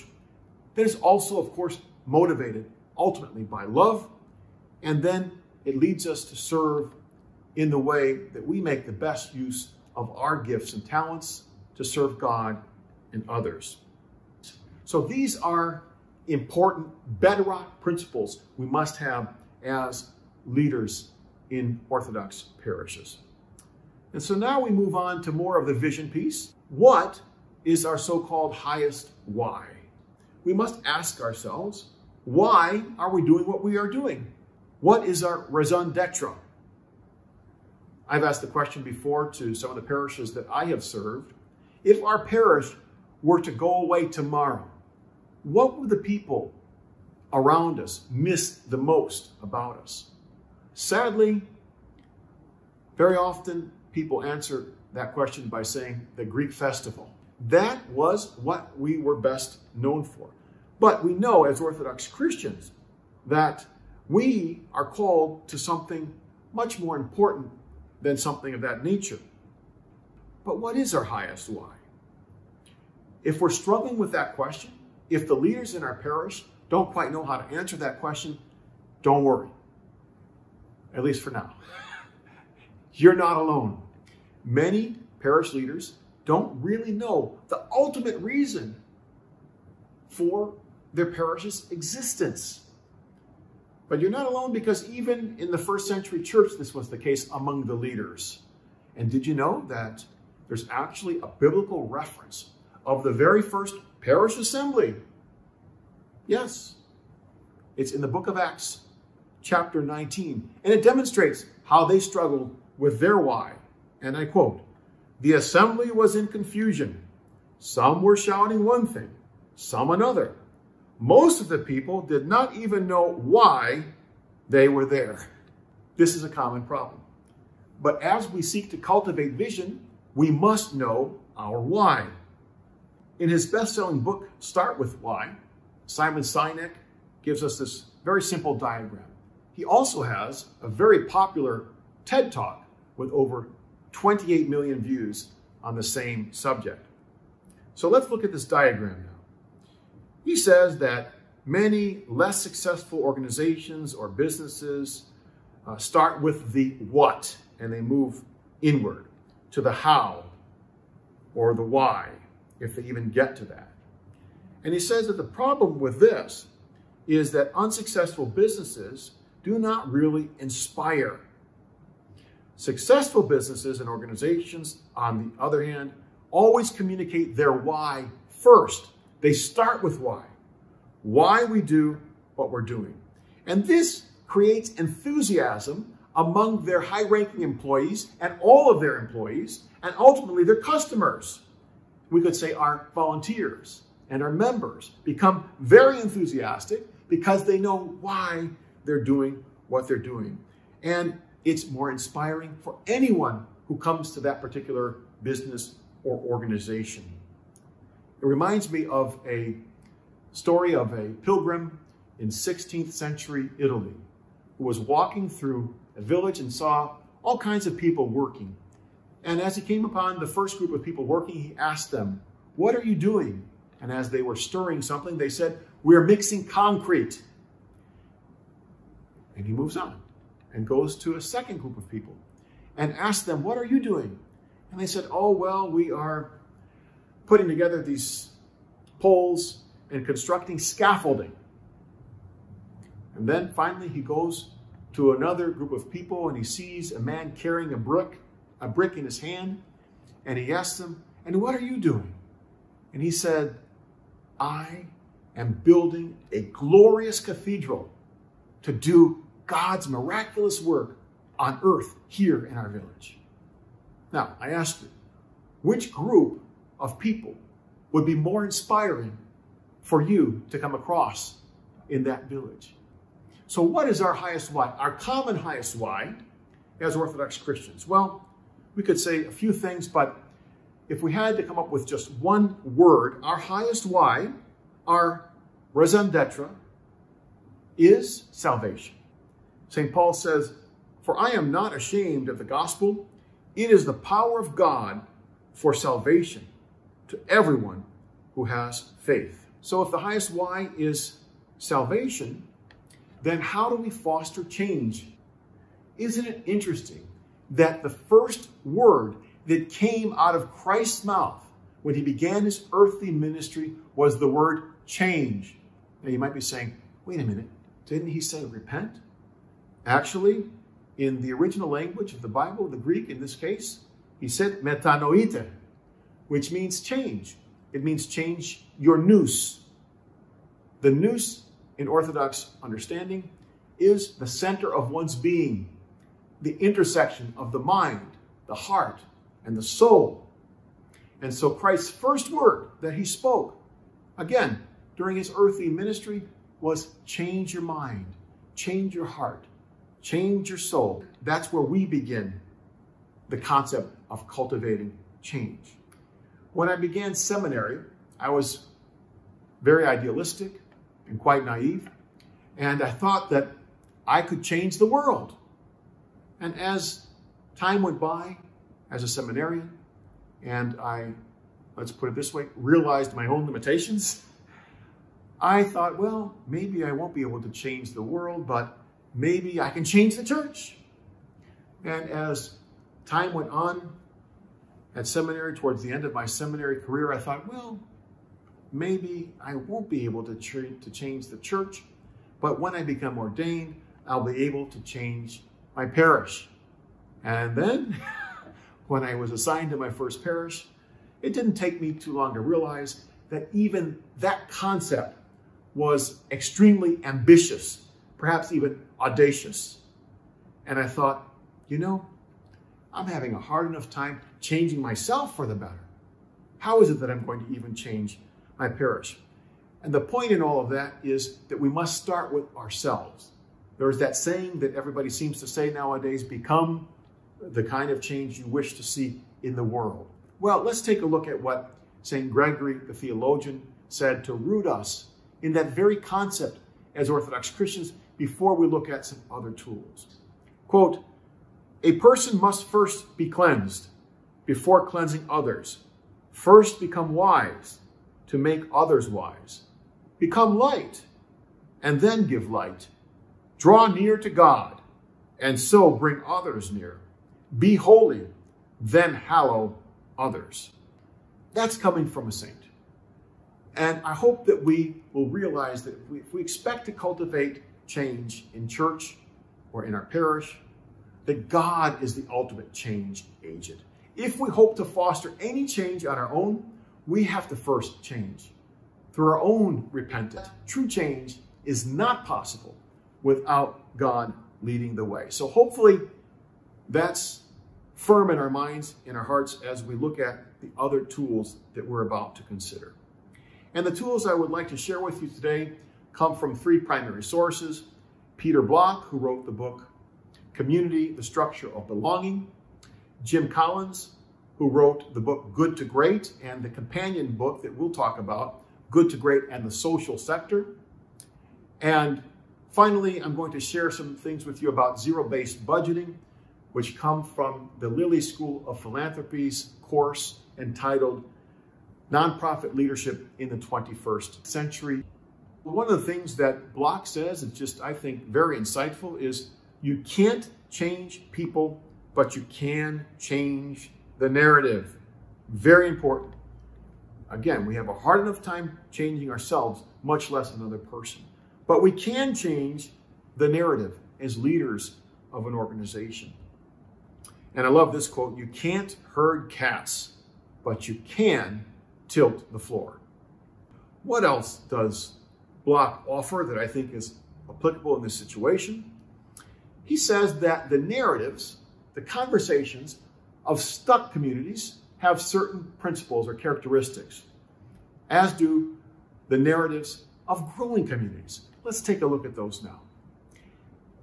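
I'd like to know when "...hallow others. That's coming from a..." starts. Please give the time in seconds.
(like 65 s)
459 s.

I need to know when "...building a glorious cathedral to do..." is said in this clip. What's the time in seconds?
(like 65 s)
255 s.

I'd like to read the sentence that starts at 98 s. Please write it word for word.
And did you know that there's actually a biblical reference of the very first parish assembly?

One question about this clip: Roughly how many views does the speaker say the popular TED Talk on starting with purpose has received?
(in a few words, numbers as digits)
28 million.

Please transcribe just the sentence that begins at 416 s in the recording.
How is it that I'm going to even change my parish?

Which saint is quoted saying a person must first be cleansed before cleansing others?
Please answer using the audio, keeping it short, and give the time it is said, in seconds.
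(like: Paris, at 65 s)
St. Gregory the Theologian, at 432 s.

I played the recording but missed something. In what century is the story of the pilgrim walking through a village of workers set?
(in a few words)
16th century.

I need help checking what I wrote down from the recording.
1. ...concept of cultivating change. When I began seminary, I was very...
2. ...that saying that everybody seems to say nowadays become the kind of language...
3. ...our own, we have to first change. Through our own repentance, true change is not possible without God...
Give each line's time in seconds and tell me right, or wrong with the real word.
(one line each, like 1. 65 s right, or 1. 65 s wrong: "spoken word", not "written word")
1. 353 s right
2. 423 s wrong: "change", not "language"
3. 476 s right.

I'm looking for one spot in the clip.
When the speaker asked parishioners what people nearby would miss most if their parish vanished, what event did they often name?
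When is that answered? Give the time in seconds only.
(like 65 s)
56 s.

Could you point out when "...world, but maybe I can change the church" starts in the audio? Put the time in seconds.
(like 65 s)
378 s.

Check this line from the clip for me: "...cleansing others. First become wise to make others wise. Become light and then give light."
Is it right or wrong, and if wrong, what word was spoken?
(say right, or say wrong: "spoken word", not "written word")
right.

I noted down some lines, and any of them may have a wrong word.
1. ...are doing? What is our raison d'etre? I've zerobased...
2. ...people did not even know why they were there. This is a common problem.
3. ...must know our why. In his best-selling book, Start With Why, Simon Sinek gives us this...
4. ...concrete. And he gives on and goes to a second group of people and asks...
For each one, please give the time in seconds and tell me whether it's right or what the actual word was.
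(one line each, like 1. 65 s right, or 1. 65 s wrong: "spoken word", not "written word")
1. 33 s wrong: "asked", not "zerobased"
2. 121 s right
3. 130 s right
4. 226 s wrong: "moves", not "gives".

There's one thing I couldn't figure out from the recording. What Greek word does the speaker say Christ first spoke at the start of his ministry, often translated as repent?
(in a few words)
metanoite.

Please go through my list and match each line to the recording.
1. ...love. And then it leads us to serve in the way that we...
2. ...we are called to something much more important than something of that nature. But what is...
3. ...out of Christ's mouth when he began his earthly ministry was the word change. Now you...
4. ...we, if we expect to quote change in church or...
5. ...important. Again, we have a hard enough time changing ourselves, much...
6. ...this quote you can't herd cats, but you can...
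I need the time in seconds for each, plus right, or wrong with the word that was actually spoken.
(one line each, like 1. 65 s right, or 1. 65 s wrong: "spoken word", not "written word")
1. 3 s right
2. 64 s right
3. 310 s right
4. 466 s wrong: "cultivate", not "quote"
5. 535 s right
6. 547 s right.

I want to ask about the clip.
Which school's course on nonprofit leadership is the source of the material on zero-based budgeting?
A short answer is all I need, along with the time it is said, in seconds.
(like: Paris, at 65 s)
Lilly School of Philanthropy, at 517 s.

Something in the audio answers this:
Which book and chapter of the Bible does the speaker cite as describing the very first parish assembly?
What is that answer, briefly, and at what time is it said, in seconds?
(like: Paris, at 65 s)
Acts 19, at 108 s.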